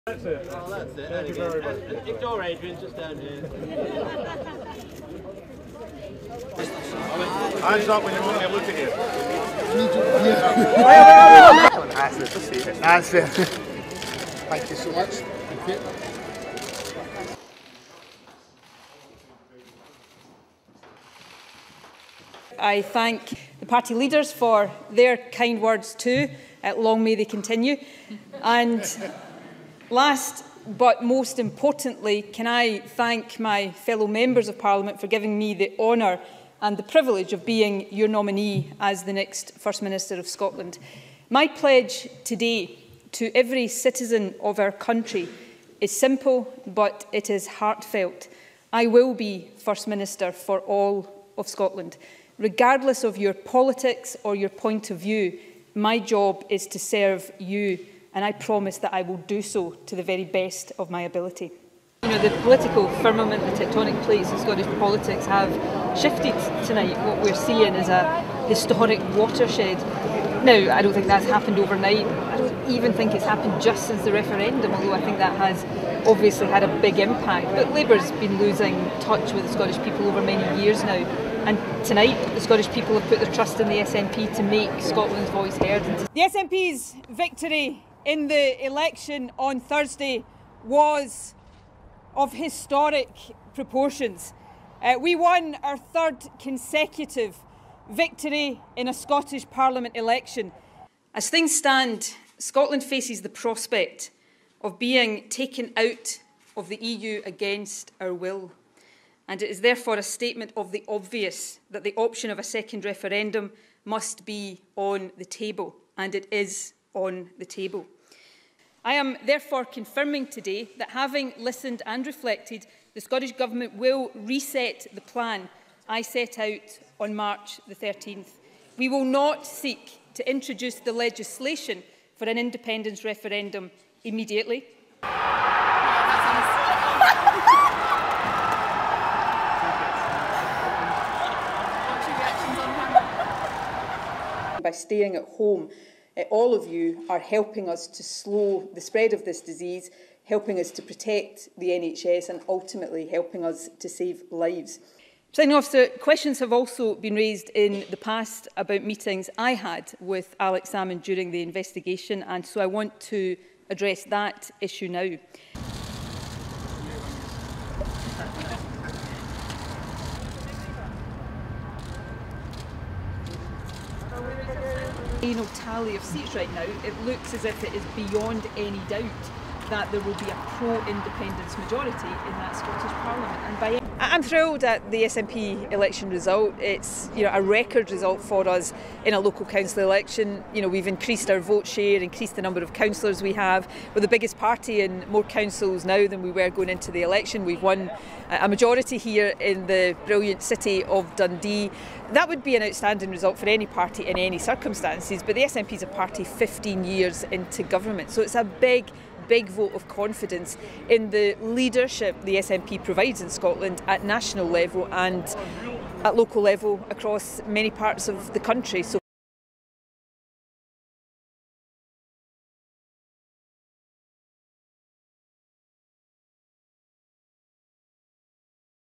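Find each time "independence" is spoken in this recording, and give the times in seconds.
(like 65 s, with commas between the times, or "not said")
132 s, 180 s.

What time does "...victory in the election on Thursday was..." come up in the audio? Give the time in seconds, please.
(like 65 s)
87 s.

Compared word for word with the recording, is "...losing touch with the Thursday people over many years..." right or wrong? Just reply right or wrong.
wrong.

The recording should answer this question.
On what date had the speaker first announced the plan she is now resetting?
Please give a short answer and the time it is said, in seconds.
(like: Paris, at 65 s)
March 13, at 127 s.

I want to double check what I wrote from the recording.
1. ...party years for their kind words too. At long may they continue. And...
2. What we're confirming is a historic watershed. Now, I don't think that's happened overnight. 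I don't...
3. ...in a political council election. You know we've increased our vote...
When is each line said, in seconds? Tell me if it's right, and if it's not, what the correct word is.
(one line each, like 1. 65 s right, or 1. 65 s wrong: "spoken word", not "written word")
1. 23 s wrong: "leaders", not "years"
2. 67 s wrong: "seeing", not "confirming"
3. 189 s wrong: "local", not "political".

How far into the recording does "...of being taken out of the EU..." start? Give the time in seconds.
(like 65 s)
104 s.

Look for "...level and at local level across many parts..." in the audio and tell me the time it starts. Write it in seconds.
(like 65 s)
214 s.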